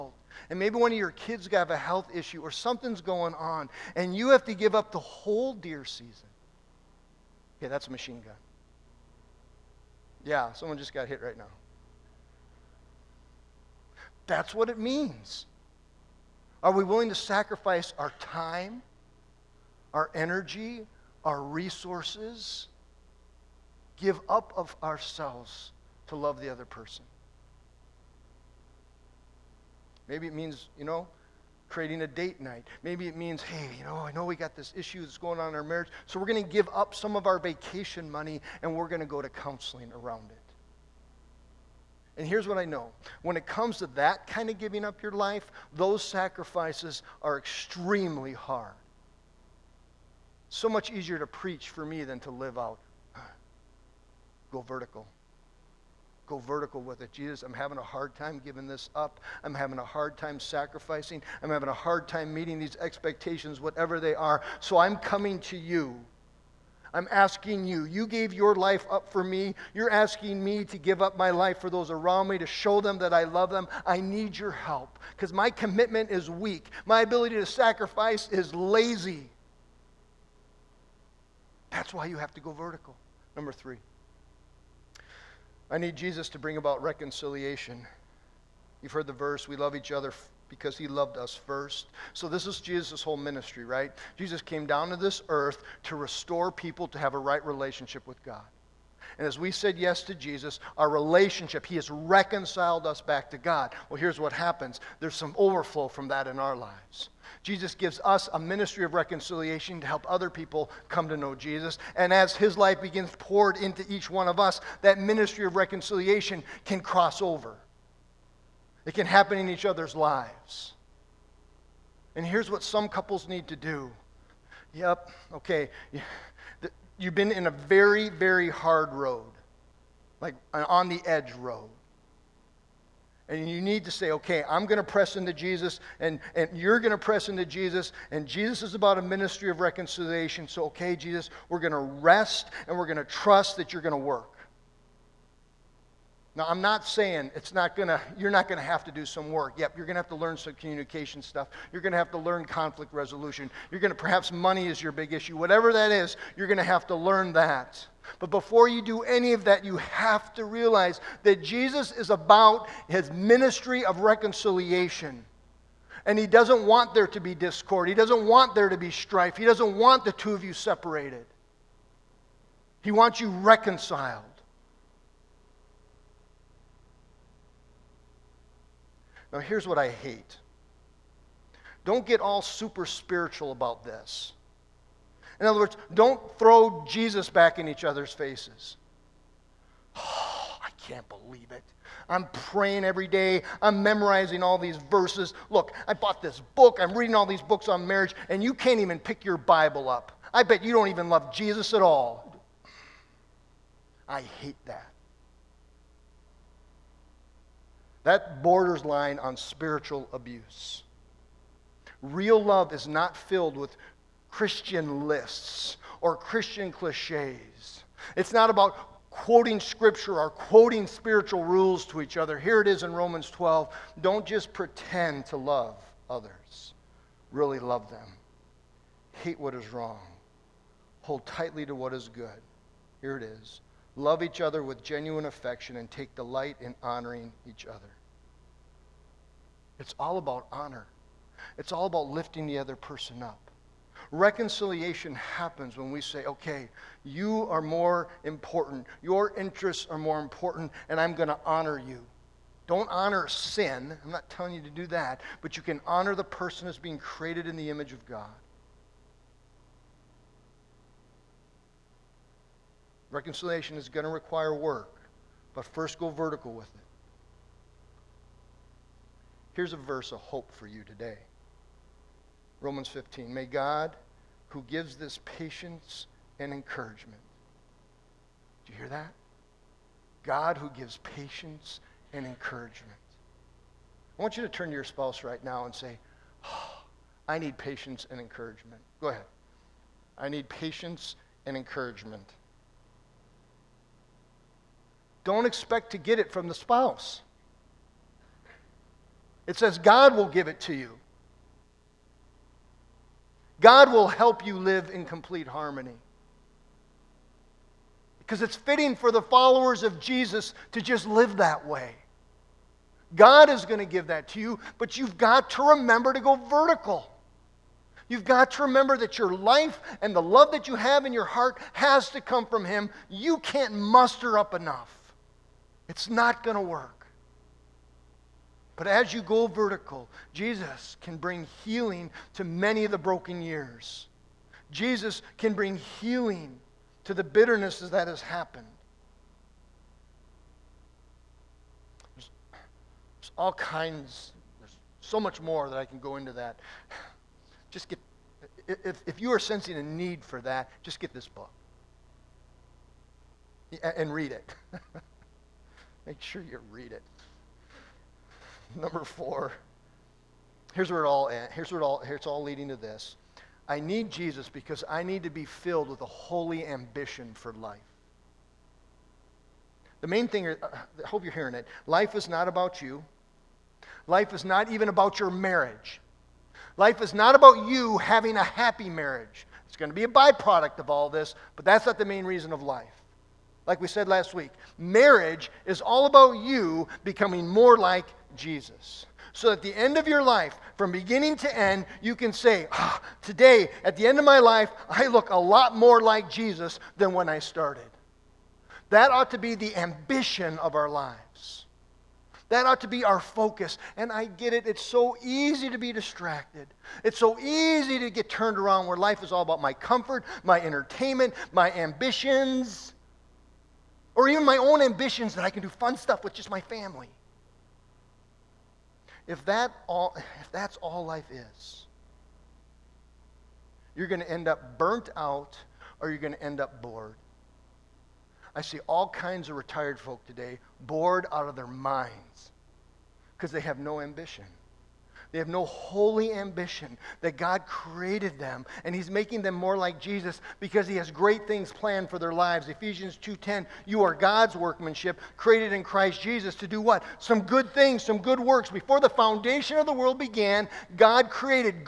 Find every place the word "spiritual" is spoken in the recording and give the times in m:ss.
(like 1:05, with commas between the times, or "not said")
3:02, 3:29, 3:40.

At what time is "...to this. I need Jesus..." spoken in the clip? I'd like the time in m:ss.
6:02.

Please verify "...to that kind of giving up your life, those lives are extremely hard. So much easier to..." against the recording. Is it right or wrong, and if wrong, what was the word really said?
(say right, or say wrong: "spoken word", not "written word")
wrong: "sacrifices", not "lives".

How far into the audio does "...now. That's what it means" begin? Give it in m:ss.
0:11.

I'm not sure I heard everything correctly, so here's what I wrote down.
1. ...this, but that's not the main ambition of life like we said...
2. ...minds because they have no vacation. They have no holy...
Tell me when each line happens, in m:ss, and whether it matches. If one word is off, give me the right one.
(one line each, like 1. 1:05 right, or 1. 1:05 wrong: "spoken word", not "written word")
1. 6:21 wrong: "reason", not "ambition"
2. 7:11 wrong: "ambition", not "vacation".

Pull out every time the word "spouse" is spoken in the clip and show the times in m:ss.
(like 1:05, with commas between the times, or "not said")
4:44, 4:56.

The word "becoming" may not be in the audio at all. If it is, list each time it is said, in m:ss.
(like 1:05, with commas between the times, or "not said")
6:27.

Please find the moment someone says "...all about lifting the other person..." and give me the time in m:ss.
4:01.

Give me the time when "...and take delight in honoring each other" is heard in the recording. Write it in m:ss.
3:55.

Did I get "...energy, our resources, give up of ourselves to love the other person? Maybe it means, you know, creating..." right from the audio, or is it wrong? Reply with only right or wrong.
right.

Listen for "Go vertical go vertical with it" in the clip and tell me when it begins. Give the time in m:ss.
0:54.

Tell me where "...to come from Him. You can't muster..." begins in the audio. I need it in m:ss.
5:22.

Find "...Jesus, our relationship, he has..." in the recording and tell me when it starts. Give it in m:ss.
1:40.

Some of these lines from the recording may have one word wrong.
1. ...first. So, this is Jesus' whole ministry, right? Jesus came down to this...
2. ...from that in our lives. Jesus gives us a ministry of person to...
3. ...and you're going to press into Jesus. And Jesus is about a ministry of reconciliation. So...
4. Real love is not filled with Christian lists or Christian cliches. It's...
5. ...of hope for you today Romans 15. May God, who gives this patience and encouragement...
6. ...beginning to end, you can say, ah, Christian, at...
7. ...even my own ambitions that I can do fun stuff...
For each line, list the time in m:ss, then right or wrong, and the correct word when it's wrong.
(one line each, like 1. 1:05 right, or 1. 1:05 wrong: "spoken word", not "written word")
1. 1:31 right
2. 1:45 wrong: "reconciliation", not "person"
3. 2:16 right
4. 3:32 right
5. 4:30 right
6. 6:30 wrong: "Today", not "Christian"
7. 6:54 right.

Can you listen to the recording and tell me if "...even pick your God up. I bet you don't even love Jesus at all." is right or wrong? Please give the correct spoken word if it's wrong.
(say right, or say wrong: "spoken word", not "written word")
wrong: "Bible", not "God".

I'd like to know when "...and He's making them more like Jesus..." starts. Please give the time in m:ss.
7:18.